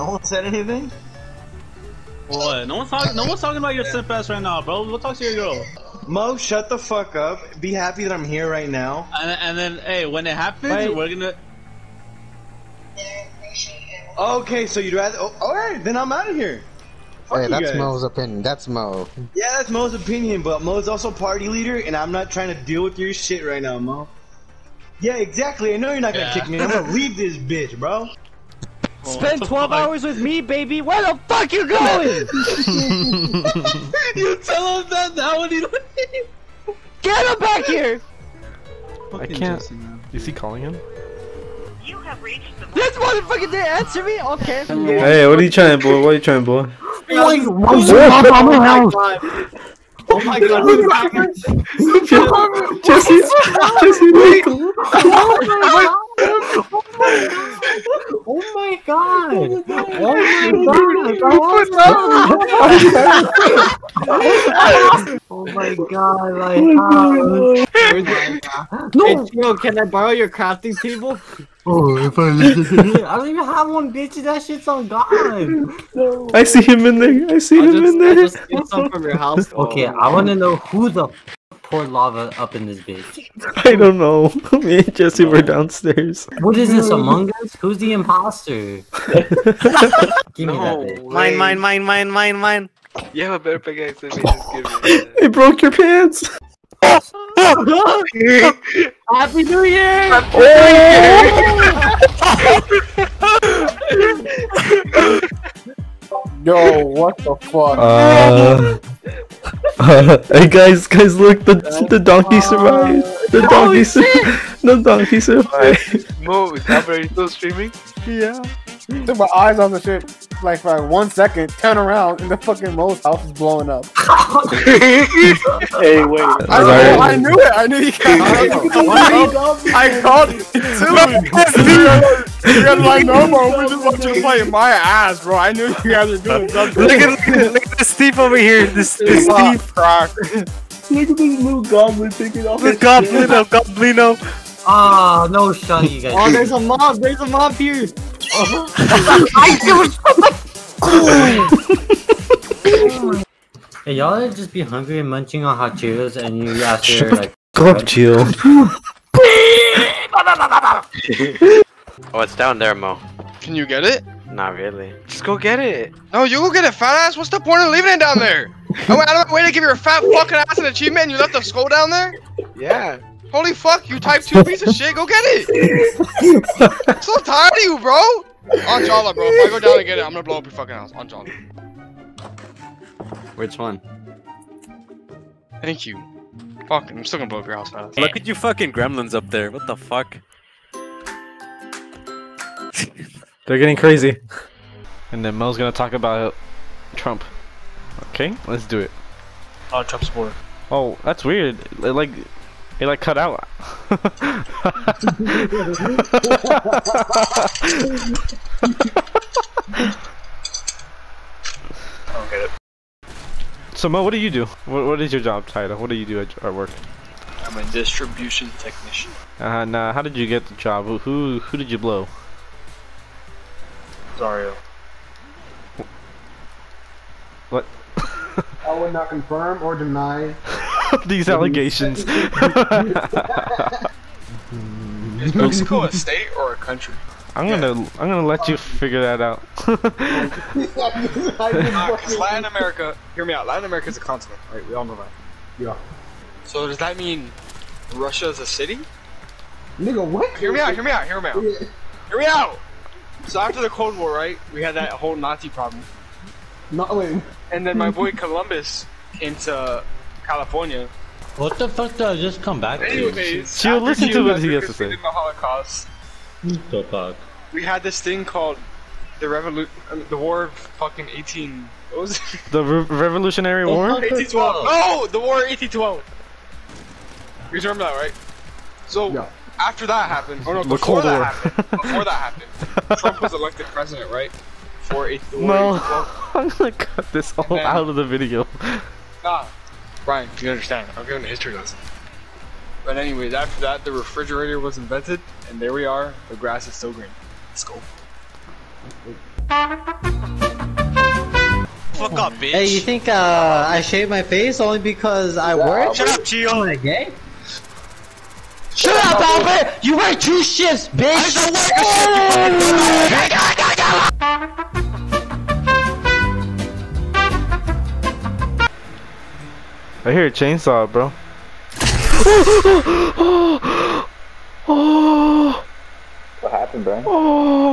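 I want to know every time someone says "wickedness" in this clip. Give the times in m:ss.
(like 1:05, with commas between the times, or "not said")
not said.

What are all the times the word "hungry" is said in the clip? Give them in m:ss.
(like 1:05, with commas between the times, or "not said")
2:34.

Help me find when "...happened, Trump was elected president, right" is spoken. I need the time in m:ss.
4:42.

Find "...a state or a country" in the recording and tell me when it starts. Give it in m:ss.
3:55.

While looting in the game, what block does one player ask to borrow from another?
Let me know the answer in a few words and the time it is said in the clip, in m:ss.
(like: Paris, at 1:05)
crafting table, at 1:10.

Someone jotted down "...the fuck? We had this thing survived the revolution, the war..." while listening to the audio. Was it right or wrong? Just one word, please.
wrong.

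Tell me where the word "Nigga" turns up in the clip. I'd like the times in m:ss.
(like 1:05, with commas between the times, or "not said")
4:09.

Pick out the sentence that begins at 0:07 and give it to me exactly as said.
Be happy that I'm here right now.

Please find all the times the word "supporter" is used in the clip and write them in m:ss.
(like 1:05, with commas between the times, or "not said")
3:20.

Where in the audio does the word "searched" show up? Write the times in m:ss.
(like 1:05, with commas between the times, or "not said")
not said.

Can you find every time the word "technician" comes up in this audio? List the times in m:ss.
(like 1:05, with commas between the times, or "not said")
3:38.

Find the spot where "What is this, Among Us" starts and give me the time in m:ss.
1:26.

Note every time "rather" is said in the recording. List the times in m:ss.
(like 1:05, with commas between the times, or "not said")
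0:14.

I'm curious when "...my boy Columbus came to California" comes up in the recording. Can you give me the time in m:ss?
4:17.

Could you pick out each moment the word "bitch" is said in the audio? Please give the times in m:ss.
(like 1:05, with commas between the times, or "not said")
0:27, 1:13, 1:22, 5:02, 5:10.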